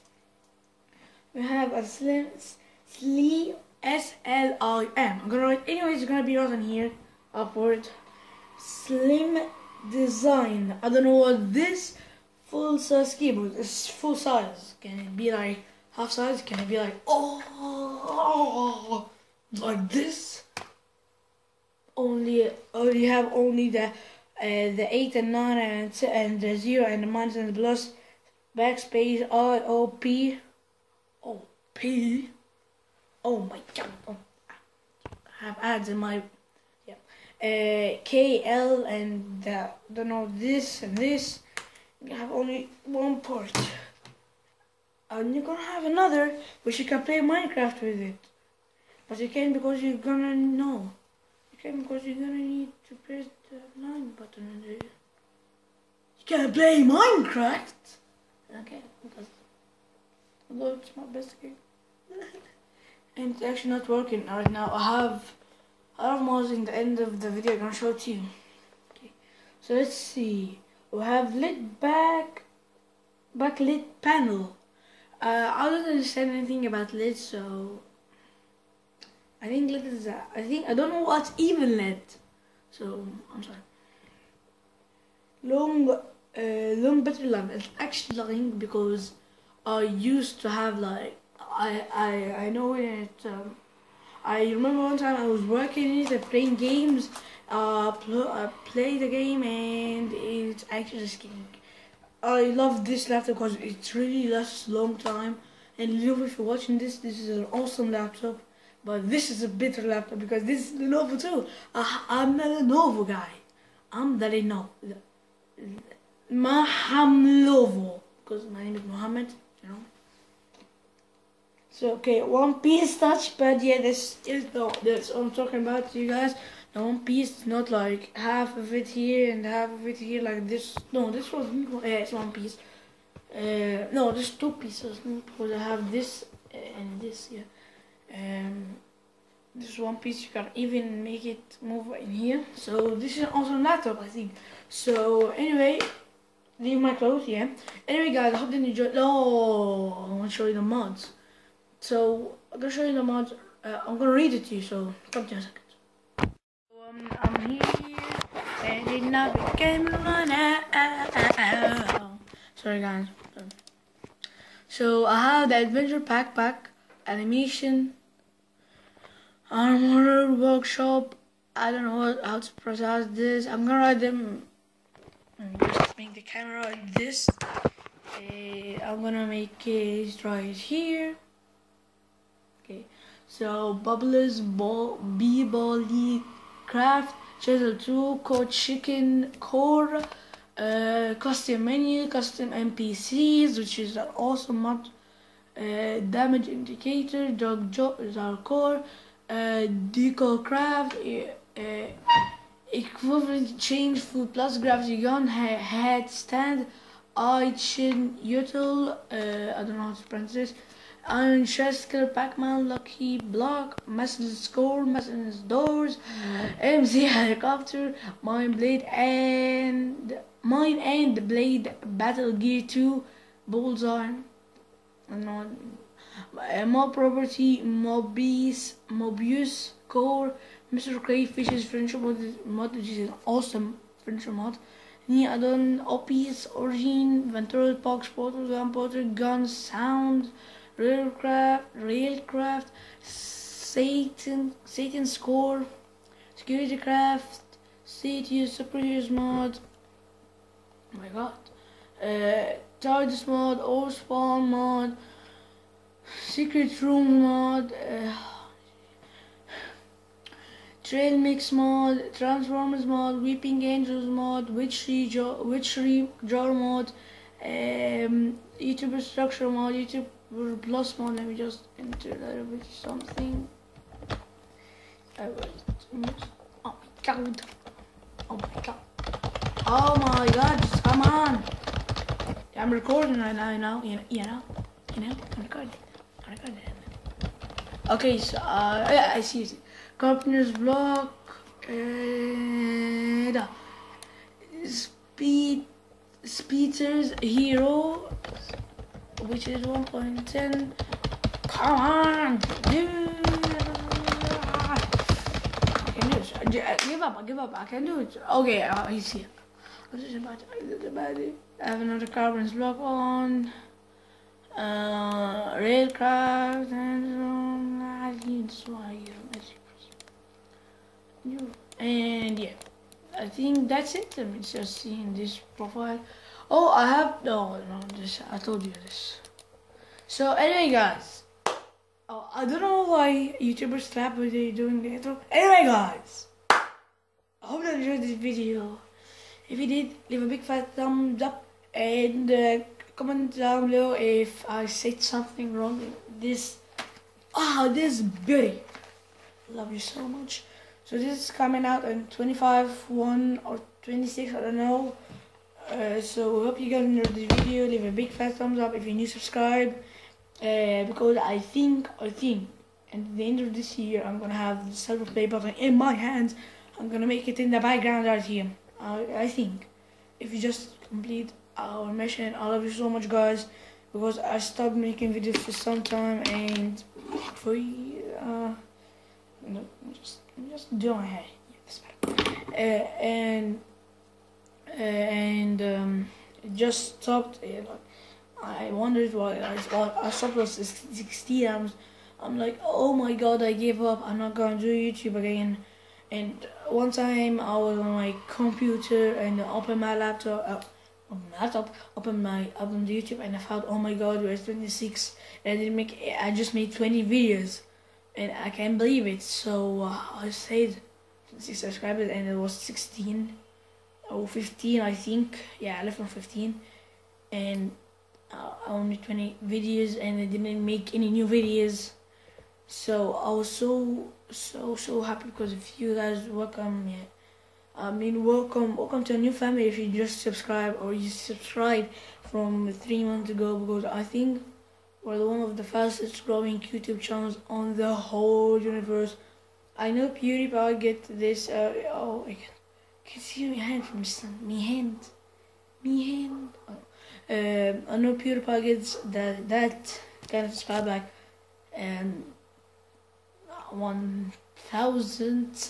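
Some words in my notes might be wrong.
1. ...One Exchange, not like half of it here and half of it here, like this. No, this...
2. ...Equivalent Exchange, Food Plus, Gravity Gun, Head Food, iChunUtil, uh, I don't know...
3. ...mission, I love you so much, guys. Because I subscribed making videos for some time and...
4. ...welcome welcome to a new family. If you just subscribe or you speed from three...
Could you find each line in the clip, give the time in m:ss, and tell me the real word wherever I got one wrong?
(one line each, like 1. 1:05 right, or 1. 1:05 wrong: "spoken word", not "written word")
1. 2:06 wrong: "Piece", not "Exchange"
2. 3:22 wrong: "Stand", not "Food"
3. 6:11 wrong: "stopped", not "subscribed"
4. 7:08 wrong: "subscribed", not "speed".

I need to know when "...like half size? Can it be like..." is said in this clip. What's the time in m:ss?
0:15.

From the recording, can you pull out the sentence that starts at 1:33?
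Um, I remember one time I was working in it, playing games.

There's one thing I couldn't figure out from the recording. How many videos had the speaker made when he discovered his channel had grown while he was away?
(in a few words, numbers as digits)
20.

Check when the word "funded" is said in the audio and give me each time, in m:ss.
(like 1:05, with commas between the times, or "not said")
not said.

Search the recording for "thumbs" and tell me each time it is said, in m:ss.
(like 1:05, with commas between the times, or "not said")
5:40, 5:58.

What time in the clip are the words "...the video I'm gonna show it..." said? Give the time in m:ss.
1:07.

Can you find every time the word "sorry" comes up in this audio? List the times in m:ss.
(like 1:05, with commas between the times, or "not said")
1:23, 2:42.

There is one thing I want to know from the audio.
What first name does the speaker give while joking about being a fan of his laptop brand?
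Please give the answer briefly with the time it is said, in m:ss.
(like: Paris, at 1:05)
Mohammed, at 1:58.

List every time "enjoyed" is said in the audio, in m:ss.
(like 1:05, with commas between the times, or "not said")
2:28, 5:37, 5:56.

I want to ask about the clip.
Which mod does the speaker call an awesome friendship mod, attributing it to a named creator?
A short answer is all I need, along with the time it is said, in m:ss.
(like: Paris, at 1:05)
Mr. Crayfish's Friendship Mod, at 3:50.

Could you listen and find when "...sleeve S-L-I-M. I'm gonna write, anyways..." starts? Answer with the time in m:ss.
0:02.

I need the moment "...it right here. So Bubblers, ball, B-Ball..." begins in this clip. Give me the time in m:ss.
2:59.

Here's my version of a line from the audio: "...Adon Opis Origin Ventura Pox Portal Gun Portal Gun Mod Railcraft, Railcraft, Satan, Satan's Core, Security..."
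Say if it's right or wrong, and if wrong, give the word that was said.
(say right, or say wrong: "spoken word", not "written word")
wrong: "Sound", not "Mod".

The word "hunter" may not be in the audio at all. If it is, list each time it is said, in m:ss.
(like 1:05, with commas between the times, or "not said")
not said.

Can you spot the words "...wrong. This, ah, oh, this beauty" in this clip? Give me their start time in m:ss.
5:45.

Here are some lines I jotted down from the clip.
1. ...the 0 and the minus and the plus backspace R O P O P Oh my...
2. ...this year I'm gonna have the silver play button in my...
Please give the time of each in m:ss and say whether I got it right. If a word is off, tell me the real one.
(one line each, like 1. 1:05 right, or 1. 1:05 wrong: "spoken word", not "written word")
1. 0:26 right
2. 6:03 right.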